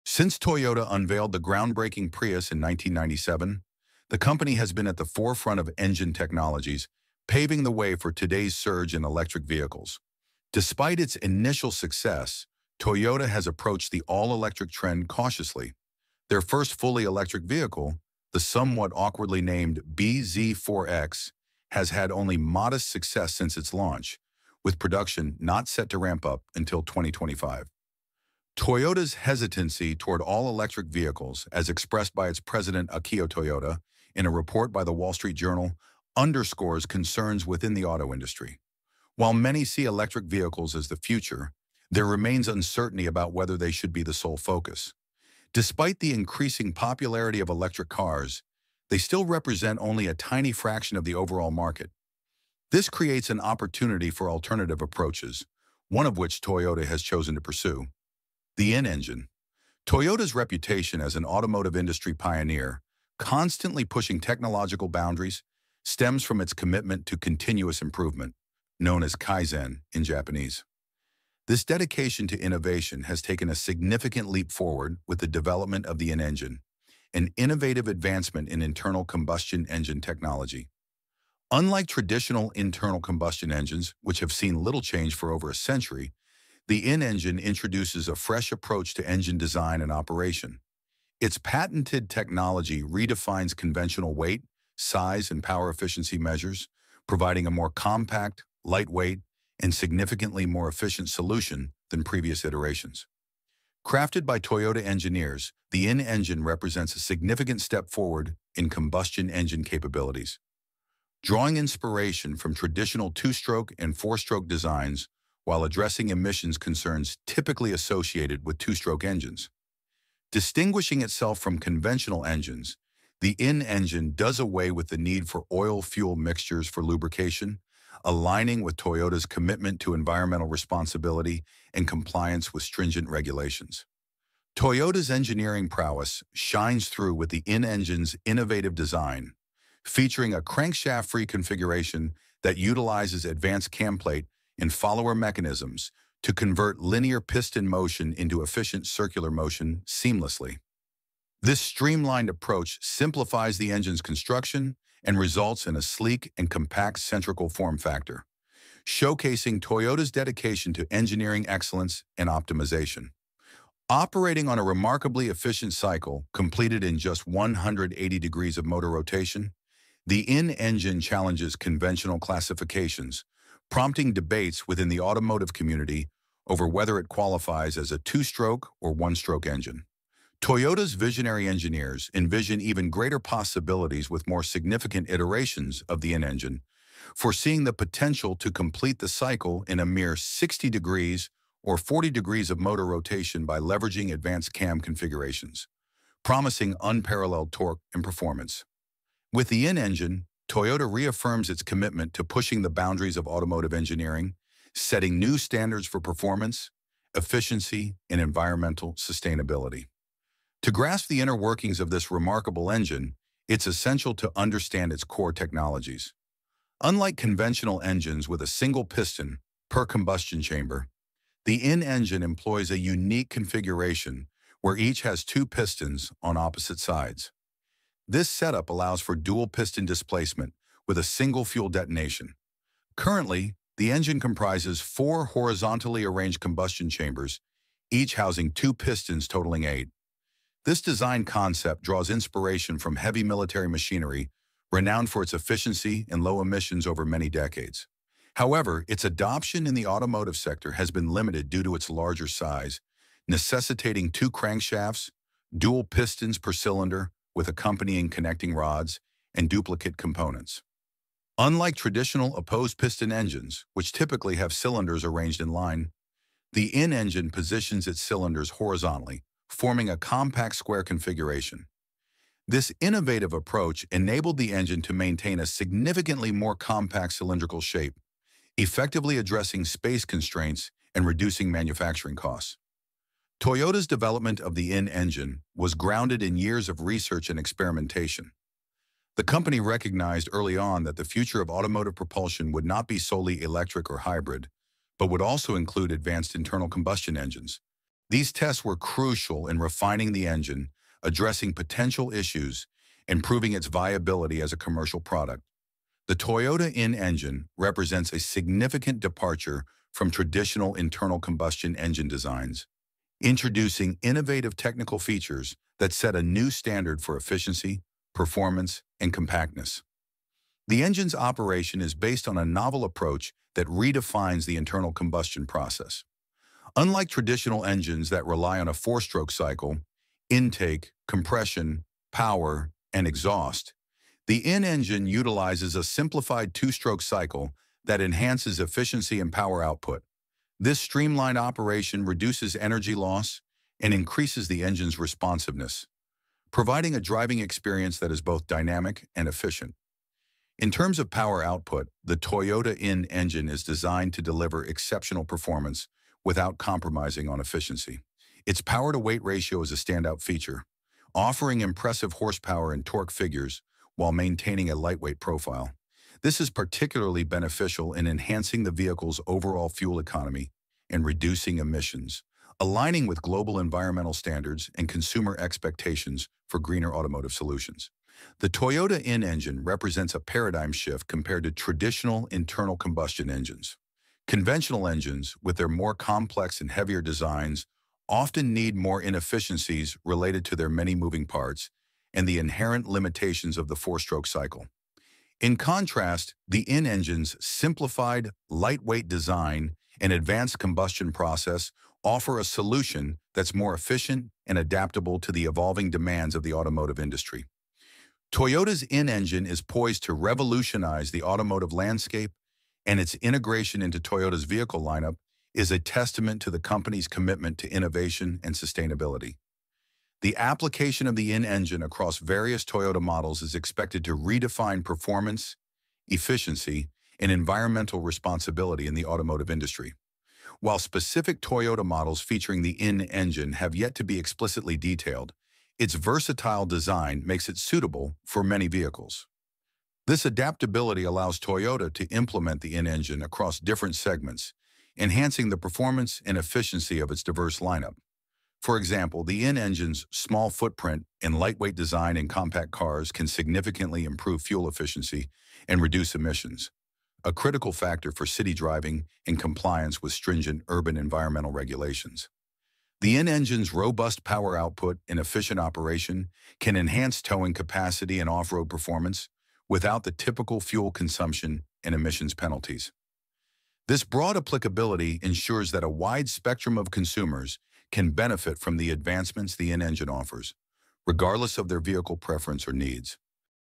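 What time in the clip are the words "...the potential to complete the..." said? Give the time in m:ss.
3:07.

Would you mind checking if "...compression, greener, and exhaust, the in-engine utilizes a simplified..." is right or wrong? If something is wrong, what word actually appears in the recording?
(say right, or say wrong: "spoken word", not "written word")
wrong: "power", not "greener".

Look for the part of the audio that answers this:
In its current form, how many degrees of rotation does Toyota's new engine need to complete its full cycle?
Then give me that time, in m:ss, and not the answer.
2:47.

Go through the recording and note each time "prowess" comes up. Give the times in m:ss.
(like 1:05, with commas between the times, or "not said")
2:15.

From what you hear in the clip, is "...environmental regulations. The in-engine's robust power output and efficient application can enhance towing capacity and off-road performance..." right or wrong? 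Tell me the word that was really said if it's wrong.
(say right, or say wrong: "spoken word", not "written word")
wrong: "operation", not "application".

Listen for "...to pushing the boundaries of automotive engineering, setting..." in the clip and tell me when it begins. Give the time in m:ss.
3:22.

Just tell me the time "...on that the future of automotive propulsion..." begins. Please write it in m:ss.
4:50.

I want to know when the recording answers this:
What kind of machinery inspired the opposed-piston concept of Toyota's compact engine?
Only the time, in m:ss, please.
4:02.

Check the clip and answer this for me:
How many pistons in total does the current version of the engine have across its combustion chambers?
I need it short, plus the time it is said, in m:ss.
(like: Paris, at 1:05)
8, at 3:59.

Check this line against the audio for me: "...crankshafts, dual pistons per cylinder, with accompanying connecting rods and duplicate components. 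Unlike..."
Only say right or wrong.
right.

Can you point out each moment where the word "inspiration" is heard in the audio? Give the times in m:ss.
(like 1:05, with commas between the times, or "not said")
1:51, 4:02.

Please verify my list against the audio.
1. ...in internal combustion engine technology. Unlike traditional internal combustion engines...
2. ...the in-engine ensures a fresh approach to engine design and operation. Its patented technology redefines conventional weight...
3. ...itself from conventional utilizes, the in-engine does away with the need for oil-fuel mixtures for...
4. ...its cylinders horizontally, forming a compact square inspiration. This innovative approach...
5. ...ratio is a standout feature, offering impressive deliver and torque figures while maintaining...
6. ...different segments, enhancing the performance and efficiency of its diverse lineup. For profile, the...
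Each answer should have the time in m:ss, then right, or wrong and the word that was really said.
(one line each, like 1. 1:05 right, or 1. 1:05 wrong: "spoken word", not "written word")
1. 1:18 right
2. 1:26 wrong: "introduces", not "ensures"
3. 2:01 wrong: "engines", not "utilizes"
4. 4:27 wrong: "configuration", not "inspiration"
5. 5:59 wrong: "horsepower", not "deliver"
6. 7:23 wrong: "example", not "profile".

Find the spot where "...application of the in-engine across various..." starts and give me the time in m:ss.
7:00.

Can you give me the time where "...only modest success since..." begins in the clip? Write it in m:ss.
0:22.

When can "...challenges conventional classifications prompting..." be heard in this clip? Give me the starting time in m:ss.
2:51.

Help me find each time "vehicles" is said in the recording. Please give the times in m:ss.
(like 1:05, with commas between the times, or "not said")
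0:09, 0:17, 0:30, 0:40, 6:08, 6:54, 7:18, 8:01.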